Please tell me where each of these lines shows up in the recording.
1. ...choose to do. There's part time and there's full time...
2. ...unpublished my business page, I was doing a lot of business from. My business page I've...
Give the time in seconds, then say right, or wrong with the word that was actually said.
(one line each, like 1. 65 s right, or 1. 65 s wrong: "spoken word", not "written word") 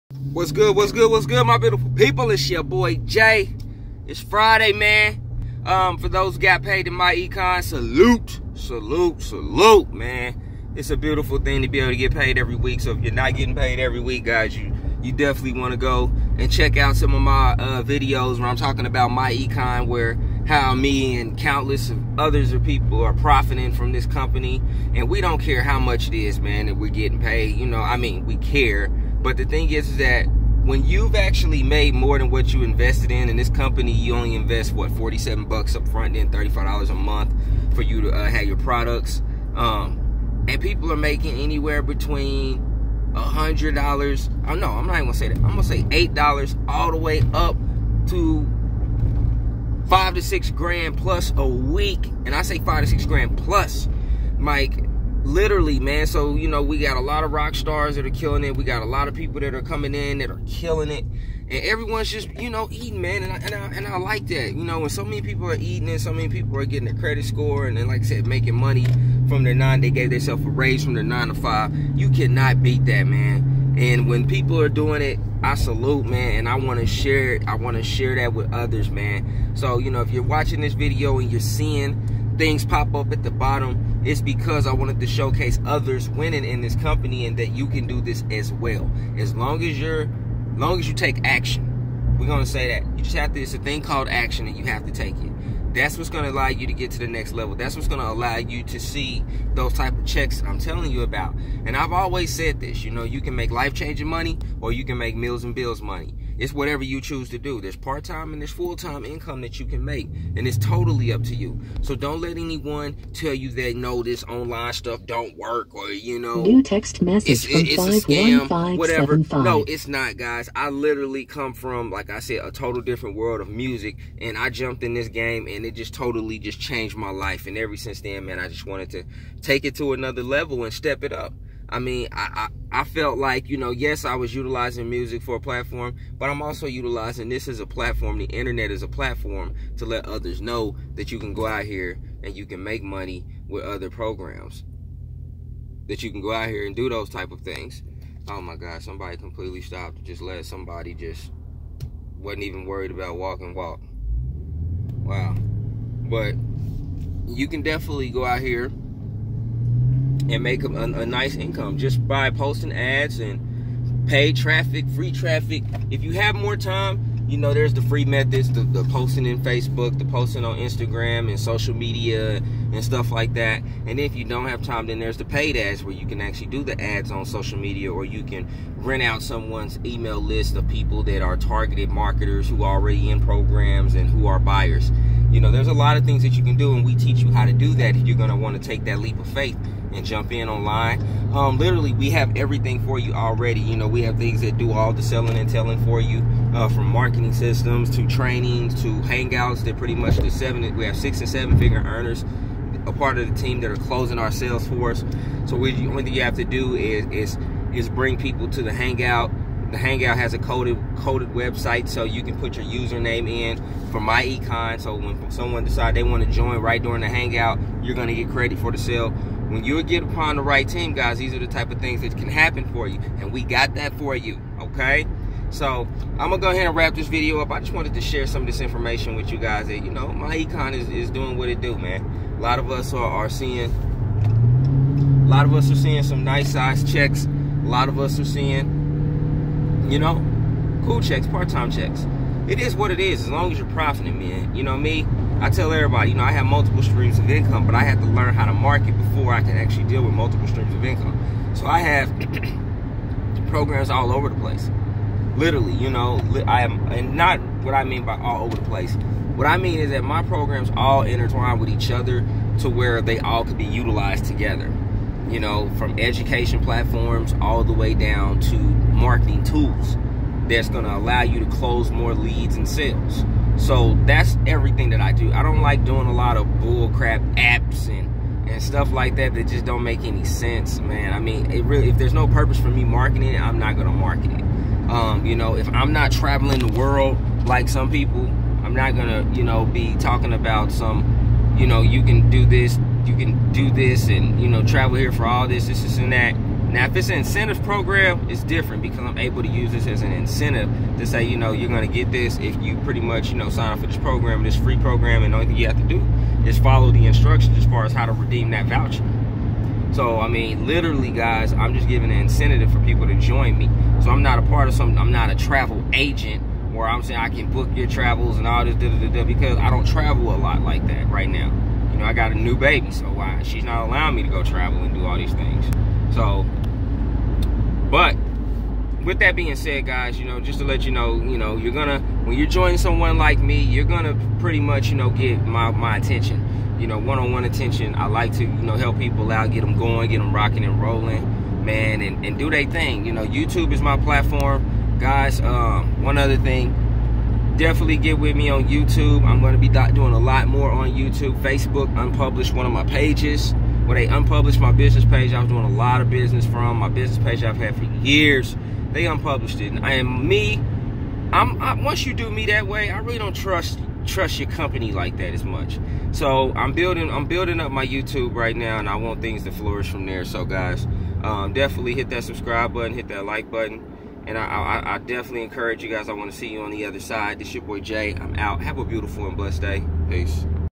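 1. 107 s right
2. 354 s right.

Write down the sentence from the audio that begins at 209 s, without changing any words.
The hangout has a coded coded website, so you can put your username in for myEcon.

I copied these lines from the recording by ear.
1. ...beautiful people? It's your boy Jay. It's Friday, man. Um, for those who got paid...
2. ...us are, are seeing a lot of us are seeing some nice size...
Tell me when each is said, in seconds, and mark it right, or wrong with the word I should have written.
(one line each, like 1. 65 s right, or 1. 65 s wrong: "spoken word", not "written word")
1. 1 s right
2. 232 s right.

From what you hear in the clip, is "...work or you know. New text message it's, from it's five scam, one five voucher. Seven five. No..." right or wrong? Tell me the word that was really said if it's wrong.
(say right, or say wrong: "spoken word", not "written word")
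wrong: "whatever", not "voucher".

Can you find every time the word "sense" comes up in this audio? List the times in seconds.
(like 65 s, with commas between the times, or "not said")
280 s.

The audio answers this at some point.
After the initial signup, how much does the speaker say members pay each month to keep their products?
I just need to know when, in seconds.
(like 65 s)
36 s.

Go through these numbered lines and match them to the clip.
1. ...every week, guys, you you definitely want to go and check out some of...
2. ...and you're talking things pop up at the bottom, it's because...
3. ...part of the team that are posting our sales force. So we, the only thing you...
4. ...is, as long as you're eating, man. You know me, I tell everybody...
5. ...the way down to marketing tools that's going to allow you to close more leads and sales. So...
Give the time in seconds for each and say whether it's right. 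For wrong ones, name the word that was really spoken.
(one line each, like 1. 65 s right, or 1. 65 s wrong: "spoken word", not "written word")
1. 13 s right
2. 81 s wrong: "seeing", not "talking"
3. 202 s wrong: "closing", not "posting"
4. 242 s wrong: "profiting", not "eating"
5. 267 s right.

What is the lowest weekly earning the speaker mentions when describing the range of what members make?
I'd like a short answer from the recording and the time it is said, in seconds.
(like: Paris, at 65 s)
$8, at 45 s.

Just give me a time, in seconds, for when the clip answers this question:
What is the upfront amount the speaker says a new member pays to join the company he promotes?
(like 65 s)
34 s.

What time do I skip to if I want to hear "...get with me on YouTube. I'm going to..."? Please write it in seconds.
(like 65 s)
347 s.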